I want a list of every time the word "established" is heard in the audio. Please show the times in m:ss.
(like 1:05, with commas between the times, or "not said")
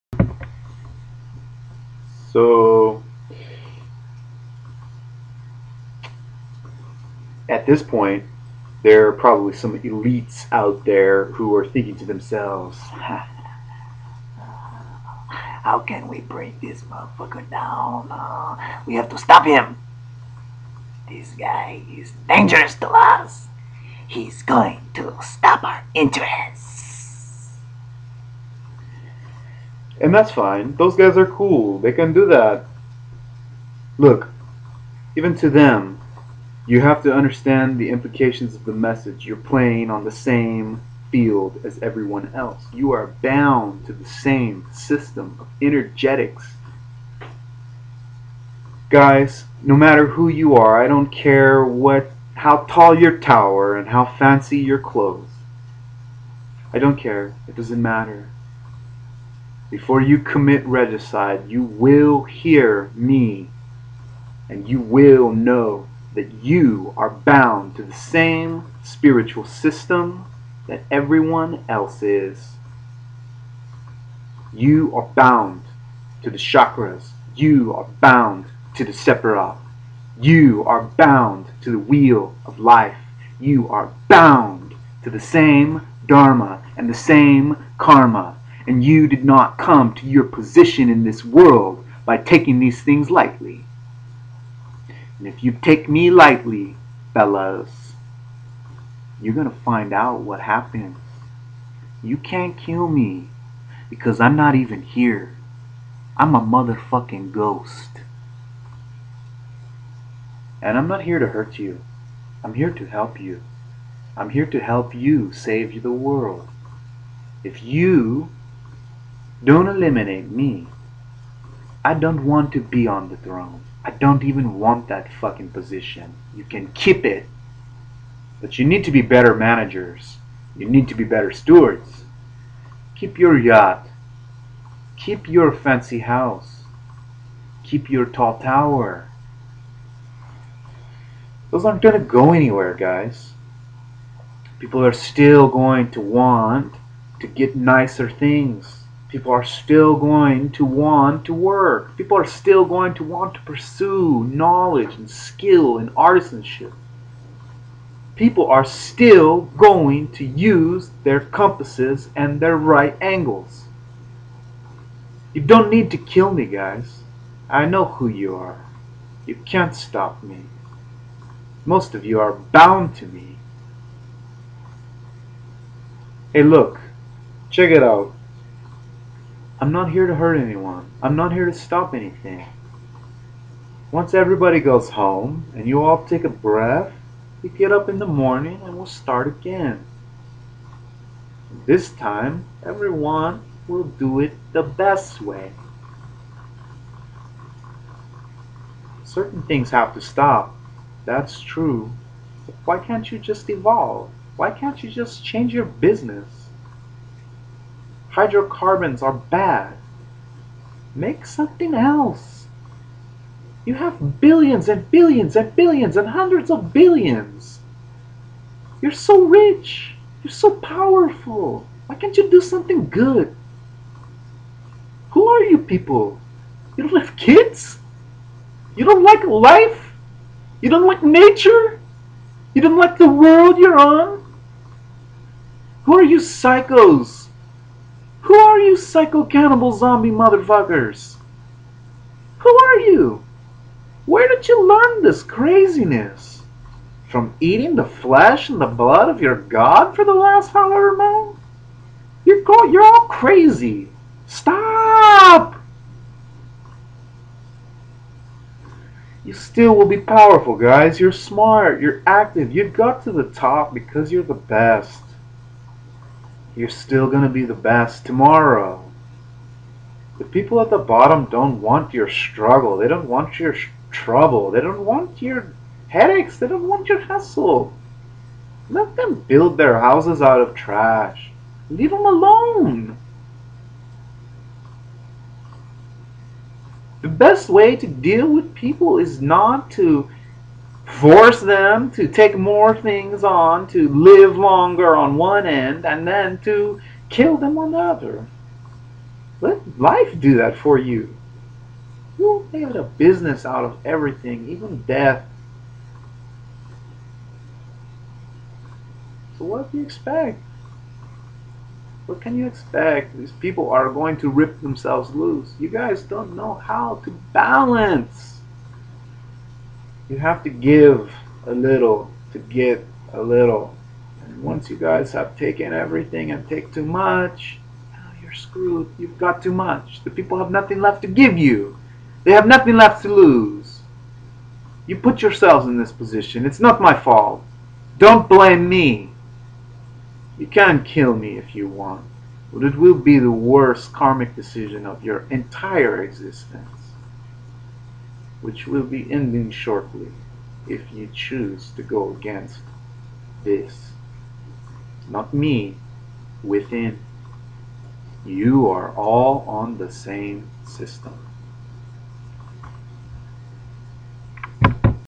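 not said.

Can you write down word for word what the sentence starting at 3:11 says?
This time, everyone will do it the best way.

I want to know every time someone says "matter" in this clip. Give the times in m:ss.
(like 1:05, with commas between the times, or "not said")
0:49, 0:57.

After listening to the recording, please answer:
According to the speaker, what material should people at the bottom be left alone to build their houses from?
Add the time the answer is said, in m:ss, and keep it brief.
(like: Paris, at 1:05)
trash, at 4:40.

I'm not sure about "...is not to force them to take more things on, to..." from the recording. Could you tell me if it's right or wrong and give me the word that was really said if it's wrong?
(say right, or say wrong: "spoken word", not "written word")
right.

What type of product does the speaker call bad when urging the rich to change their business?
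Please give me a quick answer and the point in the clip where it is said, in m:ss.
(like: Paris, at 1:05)
Hydrocarbons, at 3:28.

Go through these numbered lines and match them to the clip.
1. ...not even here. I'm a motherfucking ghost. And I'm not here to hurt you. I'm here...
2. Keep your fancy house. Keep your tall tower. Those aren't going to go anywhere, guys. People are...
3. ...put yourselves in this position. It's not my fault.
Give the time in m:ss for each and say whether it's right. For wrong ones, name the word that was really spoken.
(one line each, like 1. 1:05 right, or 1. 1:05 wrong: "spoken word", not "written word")
1. 1:44 right
2. 2:14 right
3. 5:34 right.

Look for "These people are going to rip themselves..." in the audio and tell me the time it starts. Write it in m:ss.
5:13.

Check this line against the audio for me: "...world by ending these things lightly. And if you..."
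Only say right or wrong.
wrong.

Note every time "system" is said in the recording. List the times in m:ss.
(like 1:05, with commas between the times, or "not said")
0:44, 1:09, 6:00.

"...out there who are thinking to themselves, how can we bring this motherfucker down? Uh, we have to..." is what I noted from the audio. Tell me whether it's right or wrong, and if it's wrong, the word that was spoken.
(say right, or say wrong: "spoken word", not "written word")
right.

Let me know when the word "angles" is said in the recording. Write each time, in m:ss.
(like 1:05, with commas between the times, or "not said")
2:43.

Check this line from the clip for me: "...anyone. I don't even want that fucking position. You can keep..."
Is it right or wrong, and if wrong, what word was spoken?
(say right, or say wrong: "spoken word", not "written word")
wrong: "throne", not "anyone".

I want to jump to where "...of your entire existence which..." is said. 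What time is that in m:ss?
5:44.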